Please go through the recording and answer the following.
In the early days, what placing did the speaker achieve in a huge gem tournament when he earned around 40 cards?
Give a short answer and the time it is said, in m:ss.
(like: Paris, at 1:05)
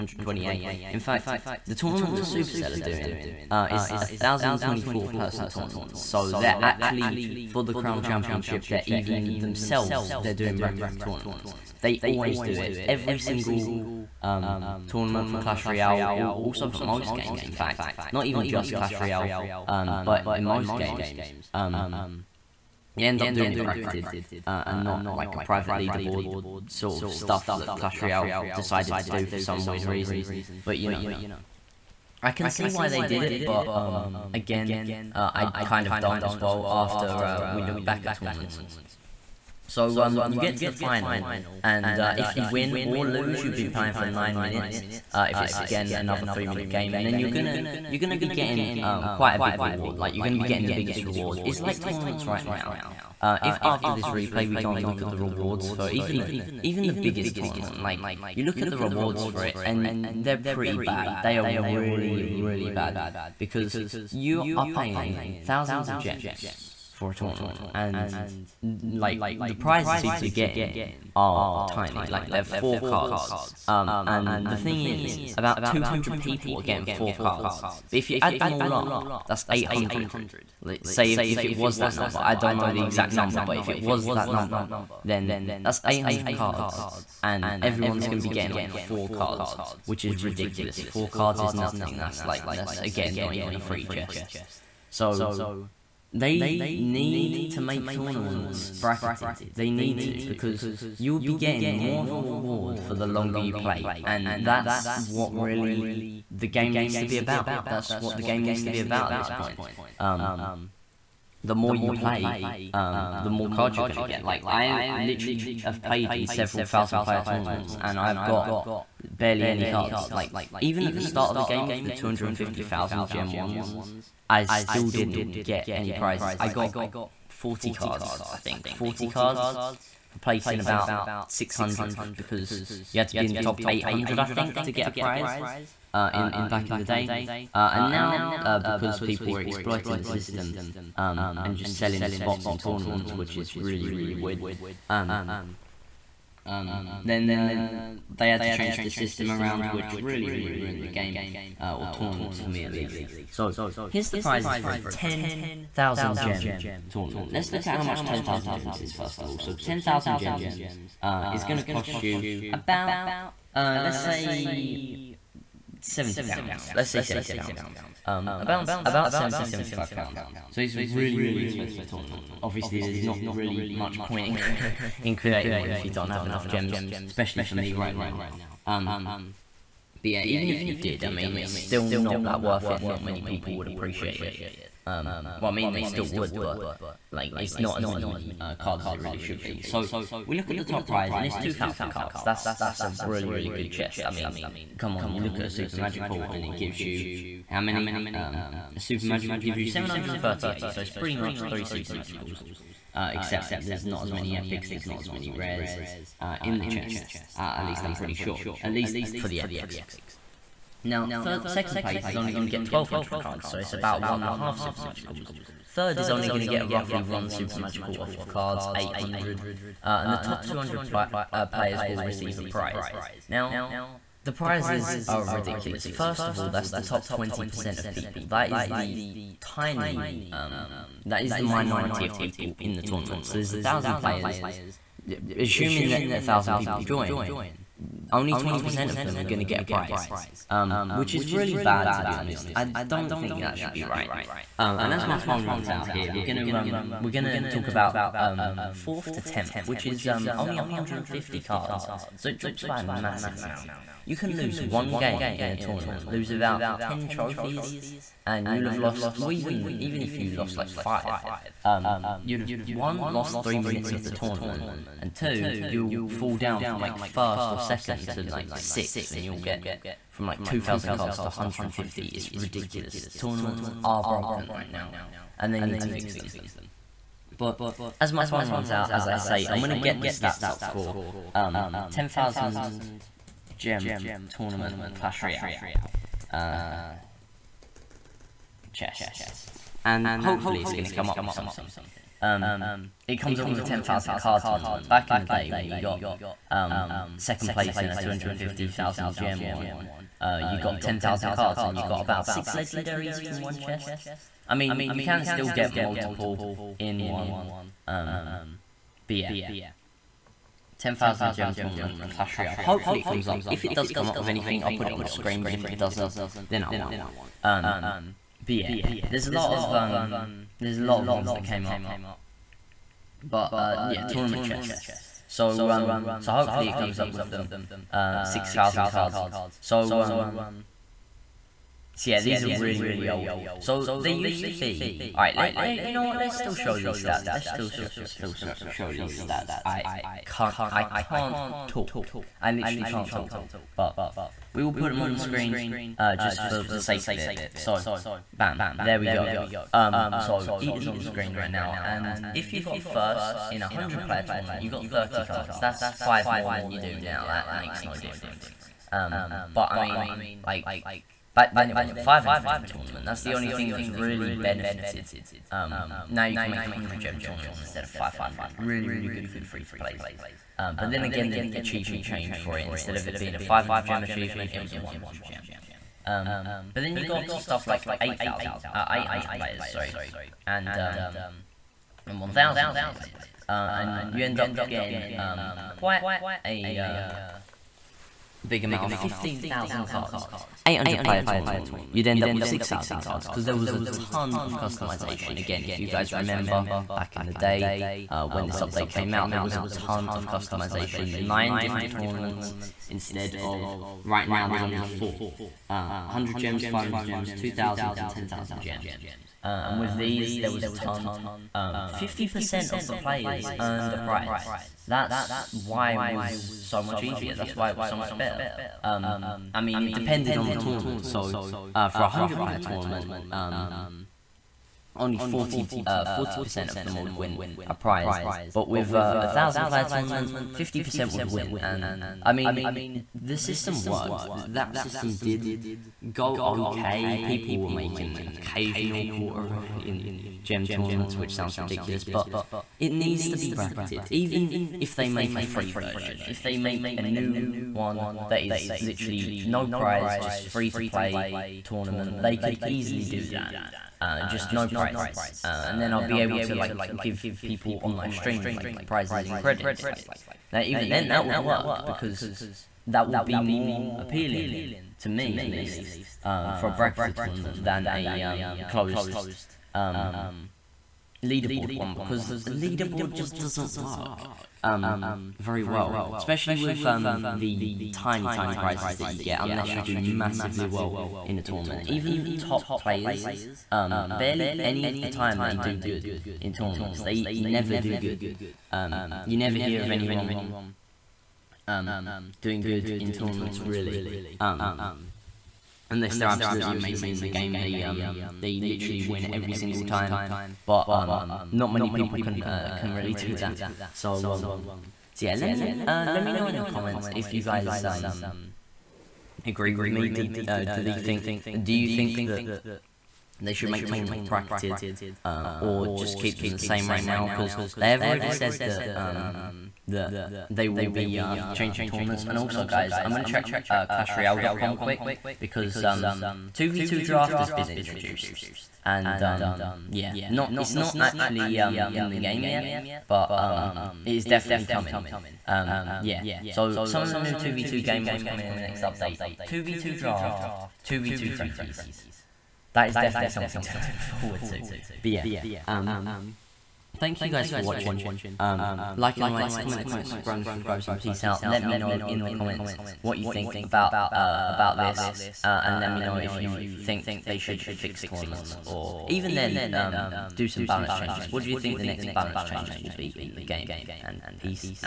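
about 600th, at 2:11.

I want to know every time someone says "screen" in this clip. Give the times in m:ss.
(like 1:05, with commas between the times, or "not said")
5:15, 5:45, 5:51.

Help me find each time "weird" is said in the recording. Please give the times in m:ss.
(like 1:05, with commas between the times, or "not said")
0:29, 2:24.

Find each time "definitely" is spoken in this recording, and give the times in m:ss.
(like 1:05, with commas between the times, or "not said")
8:54, 9:02.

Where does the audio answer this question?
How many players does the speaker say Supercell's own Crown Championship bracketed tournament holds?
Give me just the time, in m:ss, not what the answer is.
0:04.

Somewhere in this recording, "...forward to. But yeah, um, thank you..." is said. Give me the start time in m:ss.
9:03.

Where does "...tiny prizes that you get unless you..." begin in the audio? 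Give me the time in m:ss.
7:58.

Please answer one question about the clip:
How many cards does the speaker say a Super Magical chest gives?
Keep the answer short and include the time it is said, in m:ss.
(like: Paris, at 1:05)
738, at 3:19.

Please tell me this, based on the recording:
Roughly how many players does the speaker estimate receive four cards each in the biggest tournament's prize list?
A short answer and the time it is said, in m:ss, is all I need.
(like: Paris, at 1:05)
200, at 1:15.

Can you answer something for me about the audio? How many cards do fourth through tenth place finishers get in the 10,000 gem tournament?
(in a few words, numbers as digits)
150.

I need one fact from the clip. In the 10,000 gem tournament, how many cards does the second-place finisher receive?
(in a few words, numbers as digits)
1200.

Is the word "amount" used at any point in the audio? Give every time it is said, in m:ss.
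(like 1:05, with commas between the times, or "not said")
4:13, 6:28.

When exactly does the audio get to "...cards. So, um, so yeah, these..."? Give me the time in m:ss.
5:28.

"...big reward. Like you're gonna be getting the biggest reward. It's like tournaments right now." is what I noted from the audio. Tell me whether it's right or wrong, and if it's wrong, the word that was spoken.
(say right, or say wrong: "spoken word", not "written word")
right.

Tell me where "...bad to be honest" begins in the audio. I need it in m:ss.
4:01.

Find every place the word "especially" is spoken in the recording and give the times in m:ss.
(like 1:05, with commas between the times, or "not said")
2:57, 7:56.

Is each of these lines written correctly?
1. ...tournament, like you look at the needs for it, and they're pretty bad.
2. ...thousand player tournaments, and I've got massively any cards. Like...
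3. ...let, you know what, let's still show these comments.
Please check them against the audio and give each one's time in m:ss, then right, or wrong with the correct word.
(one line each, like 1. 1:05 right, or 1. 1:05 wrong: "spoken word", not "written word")
1. 0:57 wrong: "rewards", not "needs"
2. 1:56 wrong: "barely", not "massively"
3. 5:35 wrong: "stats", not "comments".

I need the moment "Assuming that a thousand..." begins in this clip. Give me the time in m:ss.
3:55.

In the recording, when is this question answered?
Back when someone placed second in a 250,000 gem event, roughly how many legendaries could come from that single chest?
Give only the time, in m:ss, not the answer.
5:02.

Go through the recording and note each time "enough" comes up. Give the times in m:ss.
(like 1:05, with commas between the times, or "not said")
2:56.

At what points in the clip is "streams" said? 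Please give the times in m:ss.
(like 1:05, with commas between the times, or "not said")
7:38.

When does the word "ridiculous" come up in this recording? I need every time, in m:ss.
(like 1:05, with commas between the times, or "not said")
1:30, 3:45, 4:32, 7:21.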